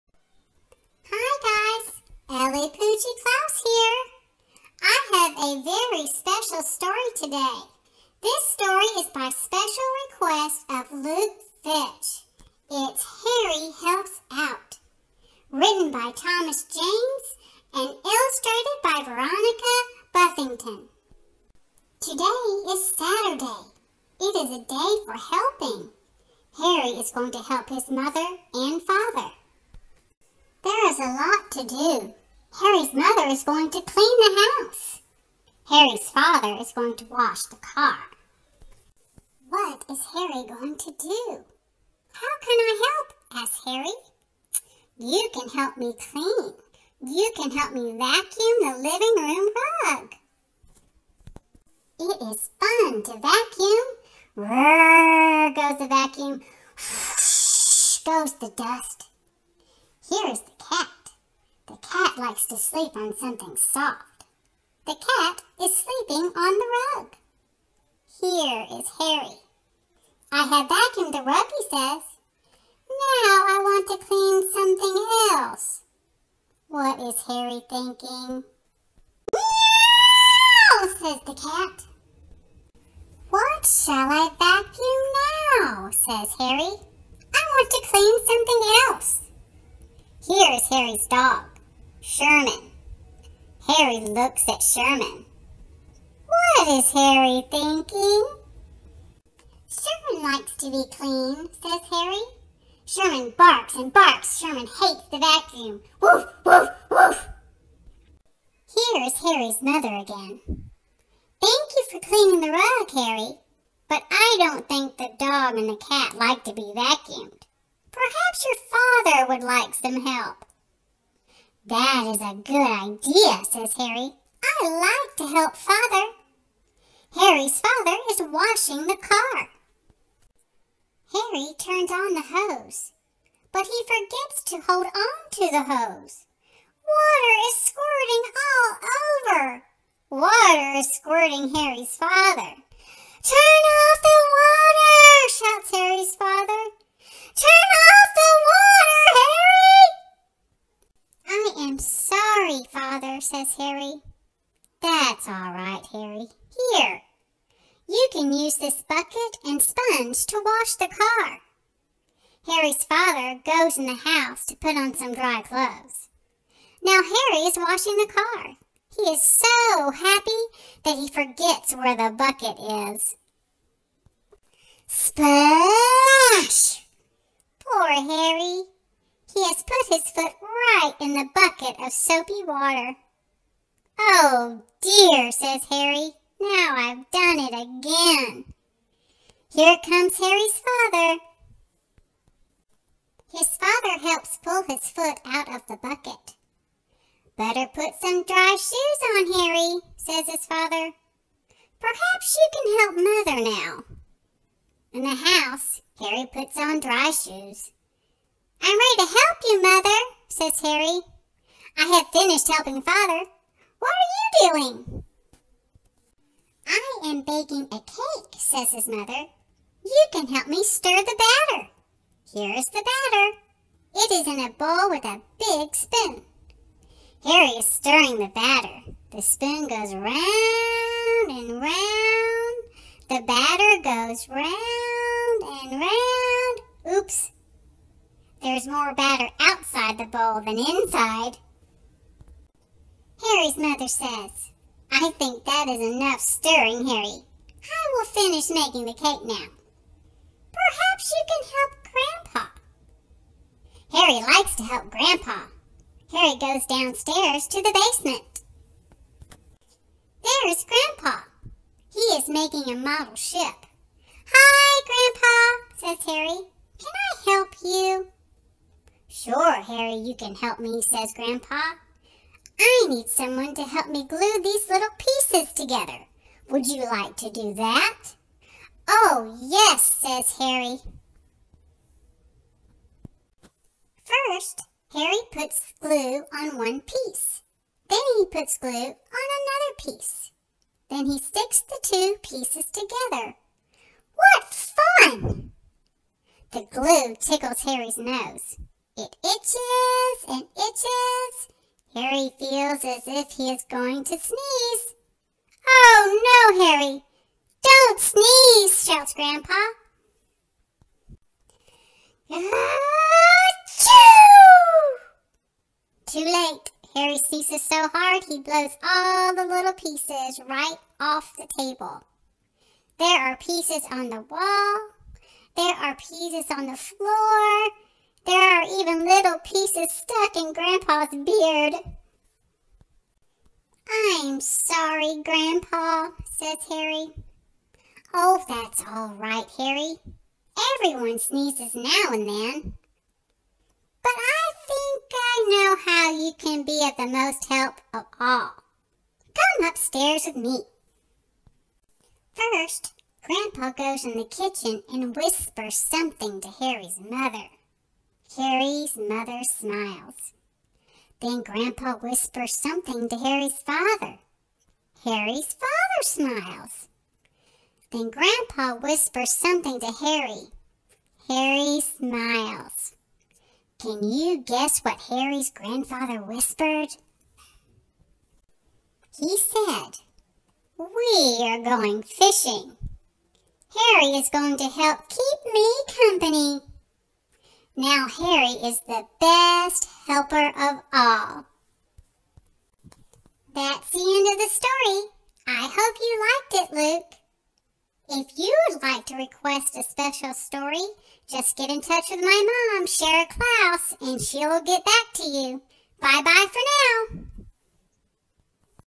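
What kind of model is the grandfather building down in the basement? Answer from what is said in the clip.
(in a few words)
ship.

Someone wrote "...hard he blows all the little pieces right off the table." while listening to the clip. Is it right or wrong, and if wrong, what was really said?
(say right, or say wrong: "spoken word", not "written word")
right.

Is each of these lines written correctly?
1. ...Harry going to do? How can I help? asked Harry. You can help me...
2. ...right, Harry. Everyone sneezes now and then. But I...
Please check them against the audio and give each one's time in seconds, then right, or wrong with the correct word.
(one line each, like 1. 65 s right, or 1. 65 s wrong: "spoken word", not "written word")
1. 40 s right
2. 339 s right.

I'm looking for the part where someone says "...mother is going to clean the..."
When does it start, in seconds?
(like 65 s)
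32 s.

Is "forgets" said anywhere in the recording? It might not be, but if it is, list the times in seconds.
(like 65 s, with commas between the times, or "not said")
133 s, 171 s.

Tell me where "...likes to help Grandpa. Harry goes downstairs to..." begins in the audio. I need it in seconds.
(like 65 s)
254 s.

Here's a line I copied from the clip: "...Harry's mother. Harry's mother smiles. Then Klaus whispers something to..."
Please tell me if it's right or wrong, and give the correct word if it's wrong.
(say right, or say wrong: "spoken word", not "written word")
wrong: "Grandpa", not "Klaus".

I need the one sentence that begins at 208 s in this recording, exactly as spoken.
I'm ready to help you, Mother, says Harry.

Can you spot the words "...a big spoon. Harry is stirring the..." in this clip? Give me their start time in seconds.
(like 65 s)
225 s.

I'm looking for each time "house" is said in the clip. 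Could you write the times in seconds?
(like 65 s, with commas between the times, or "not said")
34 s, 164 s, 205 s.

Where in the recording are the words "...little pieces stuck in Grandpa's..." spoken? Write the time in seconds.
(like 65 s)
329 s.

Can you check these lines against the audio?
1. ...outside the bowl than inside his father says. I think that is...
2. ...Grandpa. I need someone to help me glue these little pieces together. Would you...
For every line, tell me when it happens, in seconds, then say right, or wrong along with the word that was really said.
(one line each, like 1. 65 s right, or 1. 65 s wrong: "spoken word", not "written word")
1. 239 s wrong: "mother", not "father"
2. 271 s right.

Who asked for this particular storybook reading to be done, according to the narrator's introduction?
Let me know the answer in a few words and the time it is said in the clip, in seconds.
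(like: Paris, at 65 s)
Luke Fitch, at 10 s.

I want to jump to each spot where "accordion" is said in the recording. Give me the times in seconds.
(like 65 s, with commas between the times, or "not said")
not said.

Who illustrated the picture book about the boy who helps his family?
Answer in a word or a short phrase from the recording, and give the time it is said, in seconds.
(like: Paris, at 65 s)
Veronica Buffington, at 19 s.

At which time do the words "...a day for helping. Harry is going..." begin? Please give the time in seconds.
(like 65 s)
24 s.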